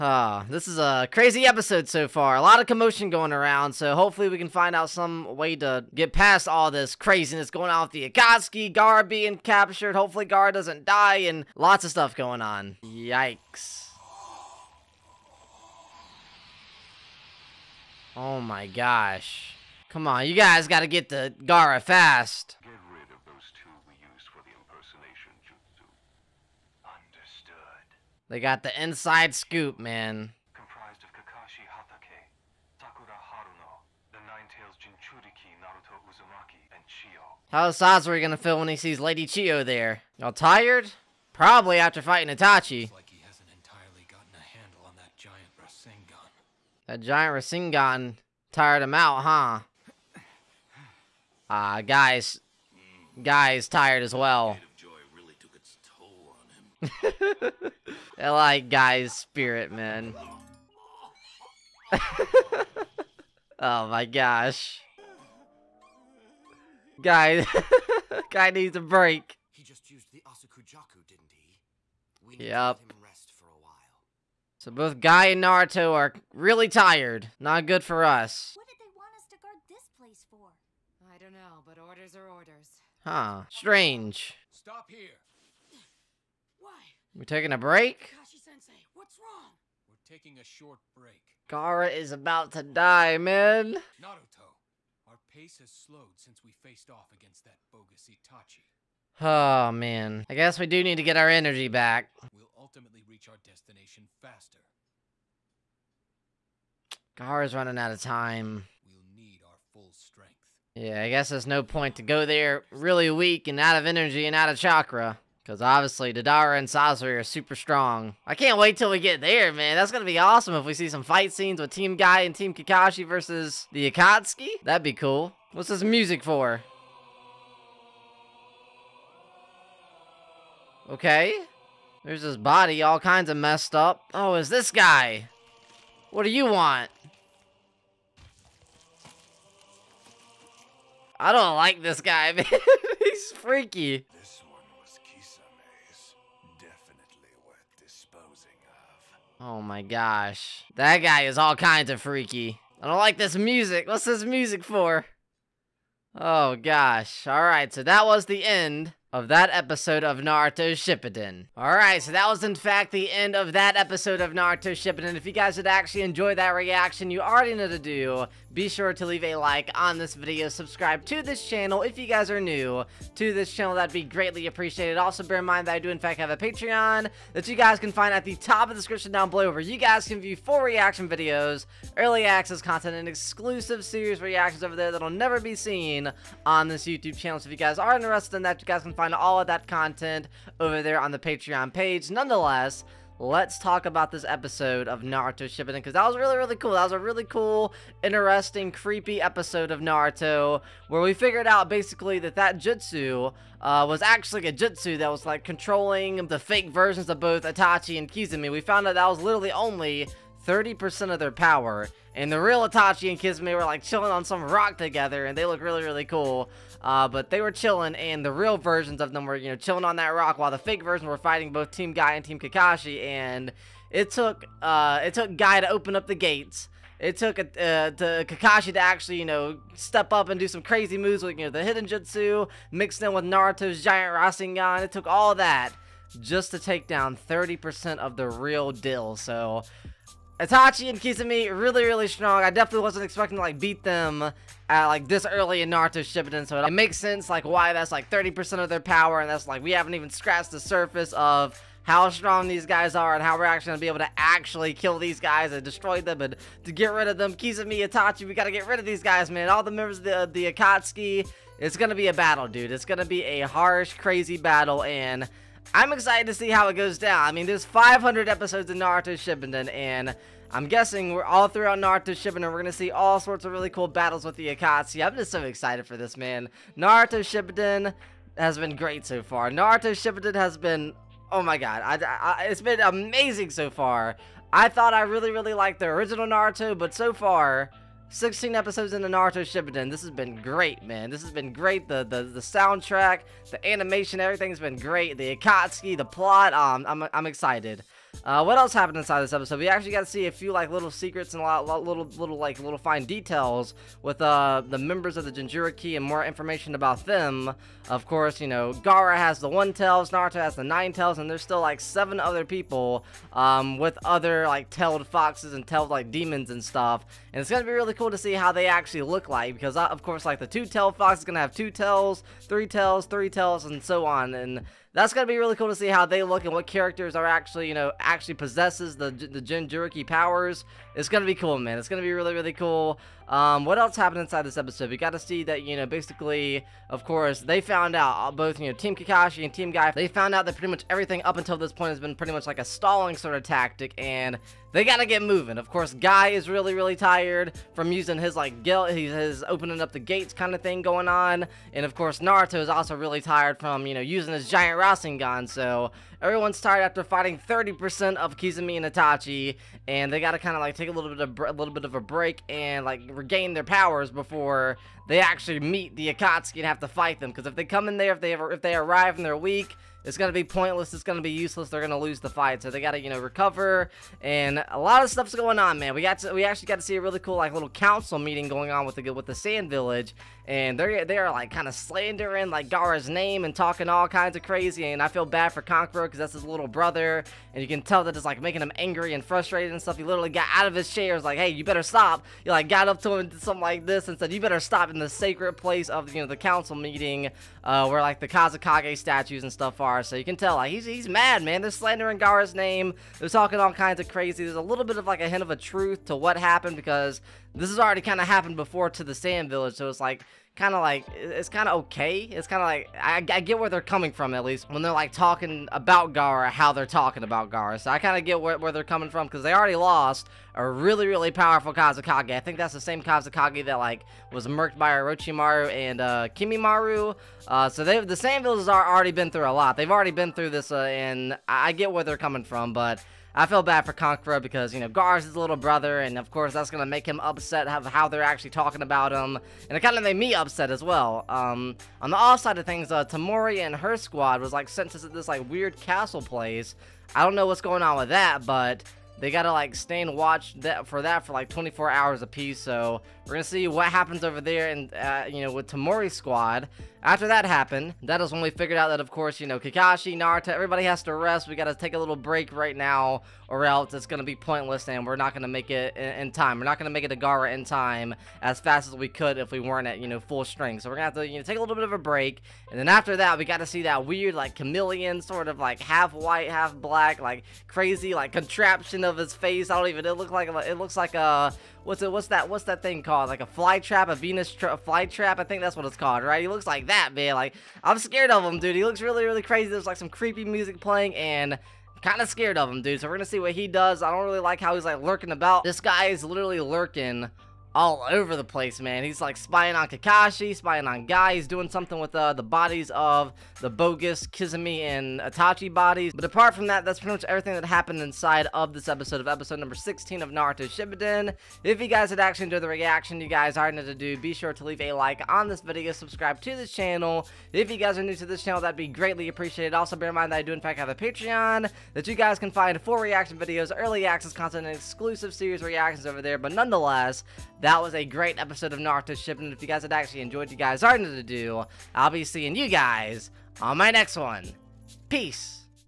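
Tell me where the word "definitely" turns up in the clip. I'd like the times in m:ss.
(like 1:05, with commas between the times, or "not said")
2:26, 4:02.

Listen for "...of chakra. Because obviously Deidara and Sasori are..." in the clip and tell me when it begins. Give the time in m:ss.
1:54.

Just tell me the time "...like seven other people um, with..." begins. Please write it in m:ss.
5:11.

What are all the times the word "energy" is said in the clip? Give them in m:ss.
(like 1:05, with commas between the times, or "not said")
1:41, 1:53.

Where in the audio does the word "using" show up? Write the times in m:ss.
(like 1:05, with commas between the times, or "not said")
5:47, 5:54.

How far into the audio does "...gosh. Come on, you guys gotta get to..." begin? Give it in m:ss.
0:18.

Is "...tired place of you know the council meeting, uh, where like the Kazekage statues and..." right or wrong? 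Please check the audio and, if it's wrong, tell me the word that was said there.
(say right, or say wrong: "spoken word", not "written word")
wrong: "sacred", not "tired".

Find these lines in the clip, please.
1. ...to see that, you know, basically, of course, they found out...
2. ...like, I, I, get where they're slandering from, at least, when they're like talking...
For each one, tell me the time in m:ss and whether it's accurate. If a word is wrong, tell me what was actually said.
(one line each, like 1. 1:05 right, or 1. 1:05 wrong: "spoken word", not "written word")
1. 5:35 right
2. 6:52 wrong: "coming", not "slandering".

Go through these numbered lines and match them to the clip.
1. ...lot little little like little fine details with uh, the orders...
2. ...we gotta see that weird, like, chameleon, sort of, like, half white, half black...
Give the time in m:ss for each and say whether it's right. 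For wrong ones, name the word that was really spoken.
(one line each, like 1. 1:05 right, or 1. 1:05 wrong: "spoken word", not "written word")
1. 5:01 wrong: "members", not "orders"
2. 7:53 right.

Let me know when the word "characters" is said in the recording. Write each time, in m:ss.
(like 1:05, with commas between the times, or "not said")
5:26.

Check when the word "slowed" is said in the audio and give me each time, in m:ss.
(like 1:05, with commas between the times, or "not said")
1:35.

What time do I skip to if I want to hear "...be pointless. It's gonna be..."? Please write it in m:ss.
6:10.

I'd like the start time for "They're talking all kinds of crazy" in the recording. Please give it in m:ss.
6:43.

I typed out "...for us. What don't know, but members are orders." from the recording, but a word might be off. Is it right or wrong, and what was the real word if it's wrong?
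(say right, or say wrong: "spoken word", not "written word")
wrong: "orders", not "members".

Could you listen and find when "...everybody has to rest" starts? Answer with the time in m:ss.
7:40.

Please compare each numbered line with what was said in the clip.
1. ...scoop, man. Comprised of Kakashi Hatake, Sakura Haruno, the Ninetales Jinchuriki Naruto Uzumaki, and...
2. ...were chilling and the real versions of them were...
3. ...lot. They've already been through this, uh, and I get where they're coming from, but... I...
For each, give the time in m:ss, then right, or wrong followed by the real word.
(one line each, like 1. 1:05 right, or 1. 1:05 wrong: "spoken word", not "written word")
1. 0:29 right
2. 3:37 right
3. 7:09 right.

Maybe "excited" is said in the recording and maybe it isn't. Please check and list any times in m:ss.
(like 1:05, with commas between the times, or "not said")
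4:25, 4:35, 4:57.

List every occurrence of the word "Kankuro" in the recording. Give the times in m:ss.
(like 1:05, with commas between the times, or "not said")
6:25, 7:13.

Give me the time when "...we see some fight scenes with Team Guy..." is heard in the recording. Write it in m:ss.
2:00.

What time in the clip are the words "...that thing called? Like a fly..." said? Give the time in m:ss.
8:02.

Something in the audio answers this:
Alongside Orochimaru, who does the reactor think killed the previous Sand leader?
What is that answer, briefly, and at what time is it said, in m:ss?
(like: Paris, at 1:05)
Kimimaro, at 7:06.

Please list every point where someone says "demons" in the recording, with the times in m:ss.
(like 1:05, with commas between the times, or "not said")
5:16.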